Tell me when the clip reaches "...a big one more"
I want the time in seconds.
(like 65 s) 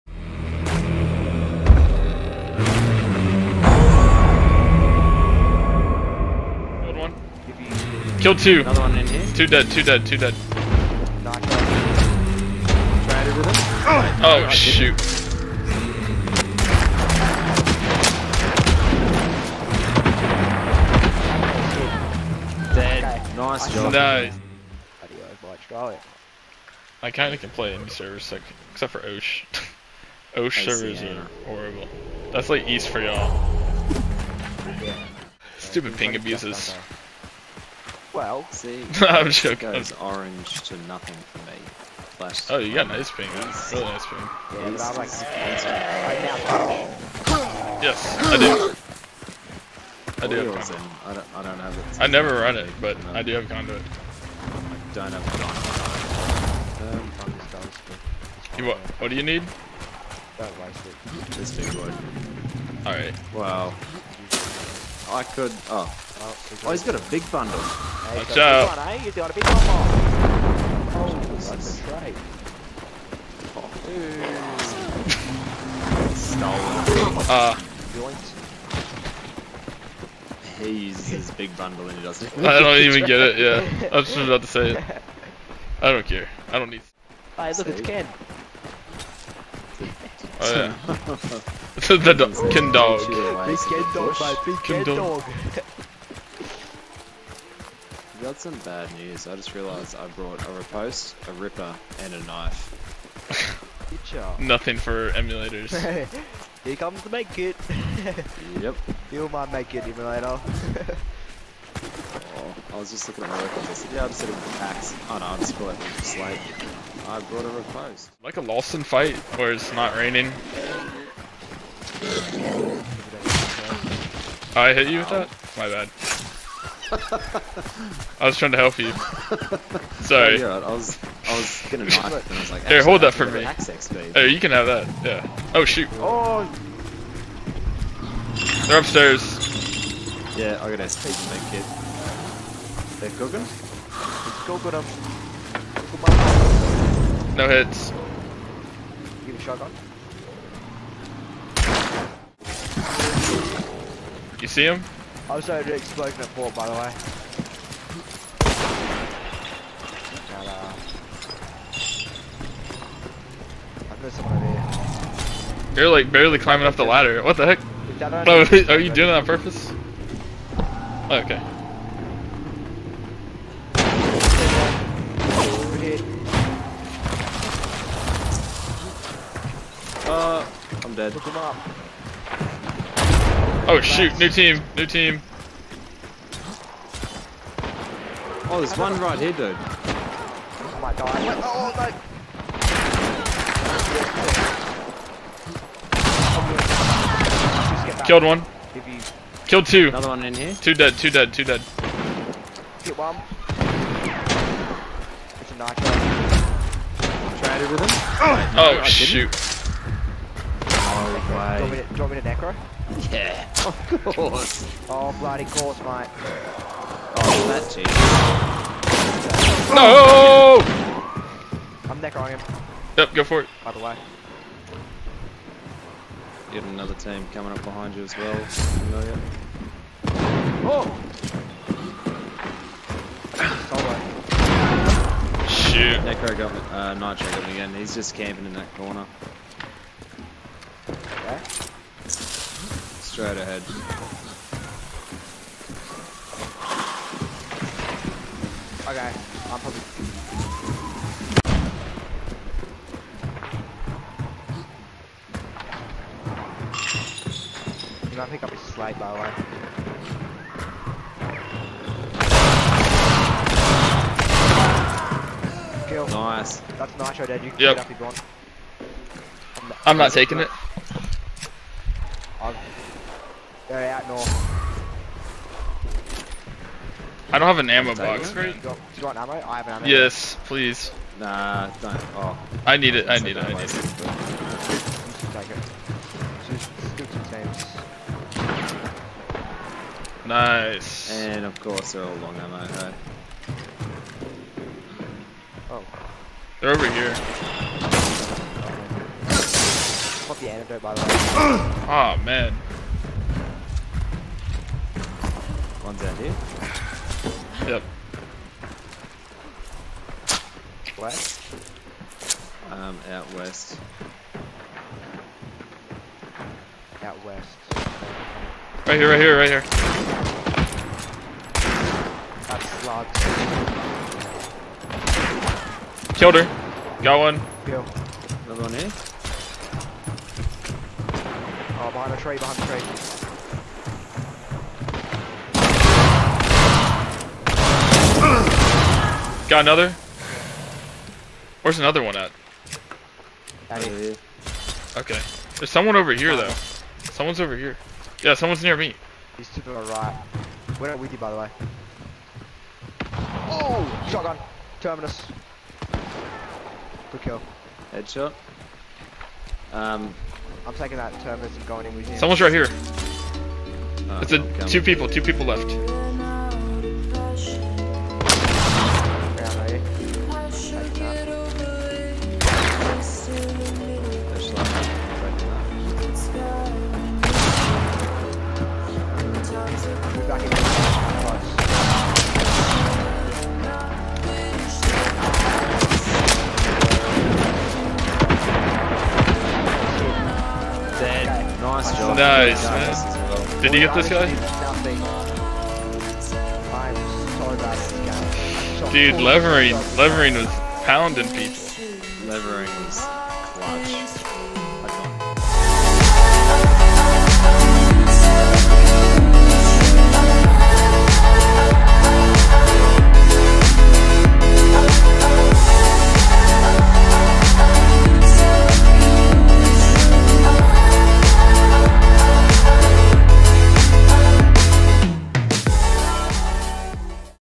69 s.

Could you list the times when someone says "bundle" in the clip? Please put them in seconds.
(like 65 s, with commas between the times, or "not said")
67 s, 81 s.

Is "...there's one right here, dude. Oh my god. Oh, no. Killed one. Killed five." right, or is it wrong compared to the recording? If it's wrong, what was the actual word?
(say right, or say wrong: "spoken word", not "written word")
wrong: "two", not "five".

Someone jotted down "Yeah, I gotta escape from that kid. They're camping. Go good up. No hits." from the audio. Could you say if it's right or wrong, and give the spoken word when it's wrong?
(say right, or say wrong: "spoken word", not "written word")
wrong: "cooking", not "camping".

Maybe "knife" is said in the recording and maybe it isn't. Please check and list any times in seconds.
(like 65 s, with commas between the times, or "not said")
102 s.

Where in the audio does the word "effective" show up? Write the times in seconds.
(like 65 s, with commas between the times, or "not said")
not said.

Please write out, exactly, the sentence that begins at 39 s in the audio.
goes orange to nothing for me.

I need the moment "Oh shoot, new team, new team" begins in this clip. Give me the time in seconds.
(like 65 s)
183 s.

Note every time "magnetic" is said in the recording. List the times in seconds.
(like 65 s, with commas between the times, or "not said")
not said.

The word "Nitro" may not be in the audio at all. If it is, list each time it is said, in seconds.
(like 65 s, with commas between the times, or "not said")
236 s, 267 s.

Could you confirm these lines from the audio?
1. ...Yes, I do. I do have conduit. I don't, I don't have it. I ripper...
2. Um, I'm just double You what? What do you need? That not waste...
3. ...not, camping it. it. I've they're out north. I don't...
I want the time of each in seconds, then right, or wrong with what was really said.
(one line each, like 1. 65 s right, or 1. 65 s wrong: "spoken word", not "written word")
1. 47 s wrong: "never", not "ripper"
2. 56 s right
3. 269 s wrong: "taking", not "camping".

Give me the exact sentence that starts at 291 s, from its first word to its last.
And of course they're all long ammo, hey?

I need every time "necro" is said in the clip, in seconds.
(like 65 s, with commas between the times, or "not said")
212 s, 236 s.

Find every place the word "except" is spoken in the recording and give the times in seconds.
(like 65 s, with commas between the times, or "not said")
28 s.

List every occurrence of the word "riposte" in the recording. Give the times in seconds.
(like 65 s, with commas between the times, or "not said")
100 s, 117 s.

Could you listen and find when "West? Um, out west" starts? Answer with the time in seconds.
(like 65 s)
310 s.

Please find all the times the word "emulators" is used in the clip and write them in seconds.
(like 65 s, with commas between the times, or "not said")
105 s, 109 s.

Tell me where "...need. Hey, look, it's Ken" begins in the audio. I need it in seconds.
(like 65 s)
86 s.